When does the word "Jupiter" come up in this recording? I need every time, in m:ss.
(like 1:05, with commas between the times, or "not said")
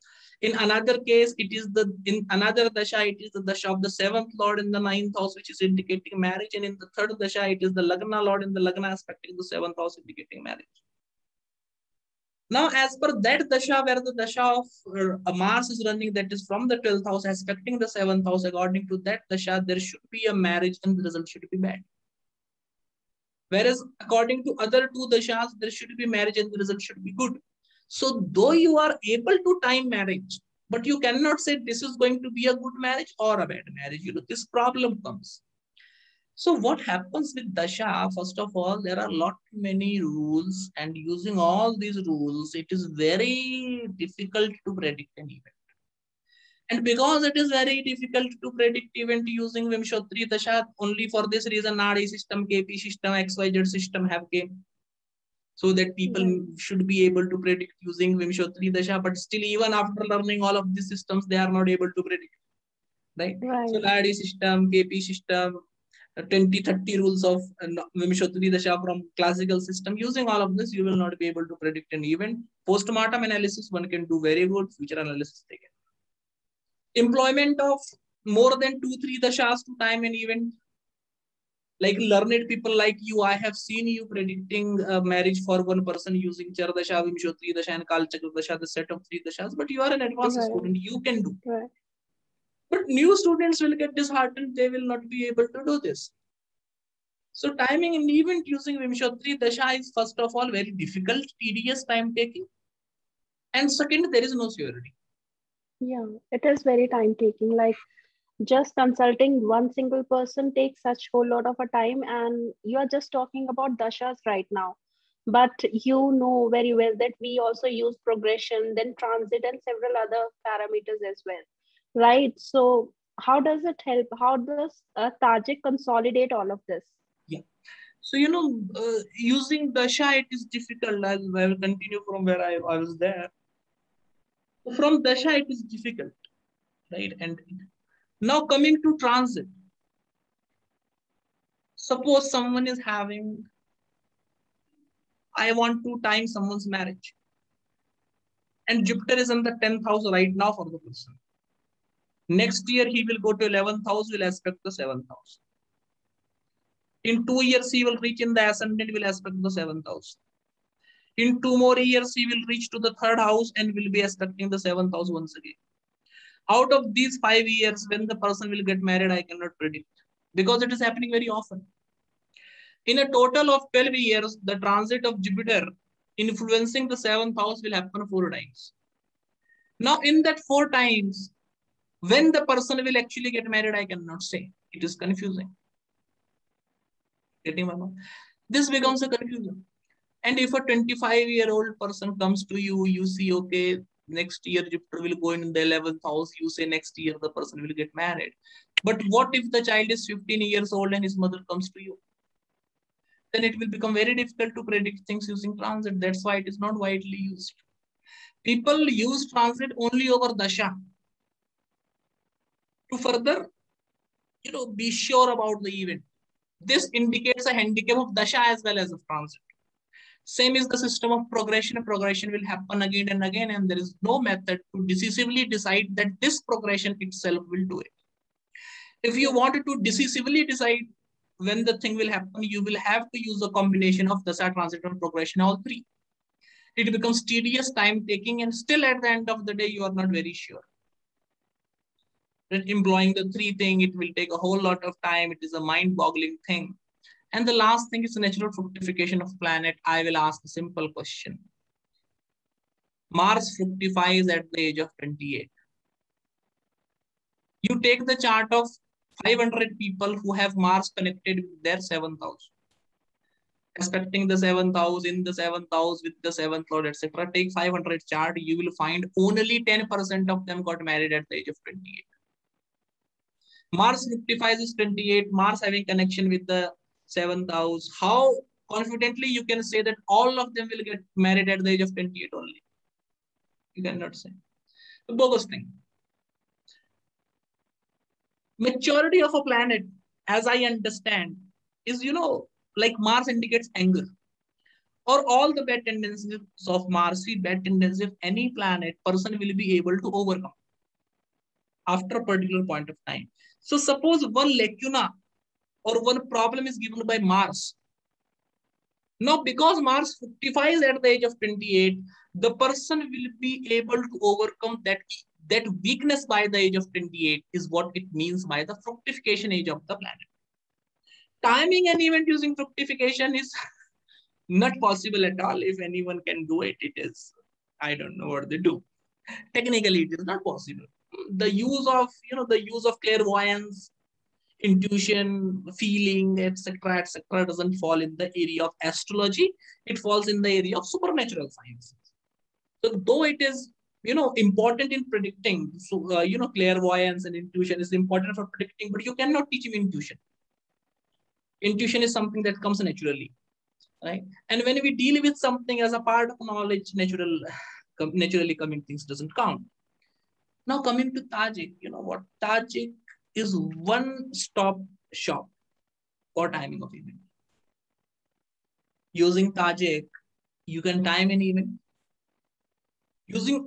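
2:28, 2:55, 3:14.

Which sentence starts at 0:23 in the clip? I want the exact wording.
Whereas according to other two dashas, there should be marriage and the result should be good.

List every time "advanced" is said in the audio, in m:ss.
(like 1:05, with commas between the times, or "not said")
1:30.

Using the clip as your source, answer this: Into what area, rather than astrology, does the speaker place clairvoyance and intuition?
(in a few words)
supernatural sciences.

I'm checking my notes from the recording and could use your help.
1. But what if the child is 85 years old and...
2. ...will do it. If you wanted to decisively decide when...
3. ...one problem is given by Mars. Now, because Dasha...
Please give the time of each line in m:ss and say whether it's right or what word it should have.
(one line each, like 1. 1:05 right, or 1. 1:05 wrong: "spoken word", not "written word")
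1. 3:18 wrong: "15", not "85"
2. 3:47 right
3. 5:06 wrong: "Mars", not "Dasha".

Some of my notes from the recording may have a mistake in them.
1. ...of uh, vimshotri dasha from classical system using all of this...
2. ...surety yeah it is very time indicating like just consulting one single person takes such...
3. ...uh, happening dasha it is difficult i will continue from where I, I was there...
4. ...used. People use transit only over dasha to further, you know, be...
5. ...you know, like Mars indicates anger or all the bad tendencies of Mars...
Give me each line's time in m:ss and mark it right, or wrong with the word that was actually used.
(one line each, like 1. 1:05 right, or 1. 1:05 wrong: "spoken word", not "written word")
1. 1:07 right
2. 1:44 wrong: "taking", not "indicating"
3. 2:08 wrong: "using", not "happening"
4. 3:27 right
5. 4:52 right.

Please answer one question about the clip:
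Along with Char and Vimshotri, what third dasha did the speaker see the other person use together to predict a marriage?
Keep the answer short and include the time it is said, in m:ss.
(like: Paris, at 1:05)
Kalchakra Dasha, at 1:27.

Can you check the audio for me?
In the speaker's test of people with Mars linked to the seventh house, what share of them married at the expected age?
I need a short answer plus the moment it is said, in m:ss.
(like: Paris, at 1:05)
10%, at 4:29.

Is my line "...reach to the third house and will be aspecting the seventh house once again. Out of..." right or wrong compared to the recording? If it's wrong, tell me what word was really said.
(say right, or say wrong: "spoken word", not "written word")
right.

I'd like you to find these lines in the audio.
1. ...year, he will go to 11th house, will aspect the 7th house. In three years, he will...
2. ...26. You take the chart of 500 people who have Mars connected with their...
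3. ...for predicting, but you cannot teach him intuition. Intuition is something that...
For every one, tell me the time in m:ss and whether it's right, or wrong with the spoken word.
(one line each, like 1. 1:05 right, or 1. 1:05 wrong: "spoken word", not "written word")
1. 2:32 wrong: "two", not "three"
2. 4:14 wrong: "28", not "26"
3. 5:48 right.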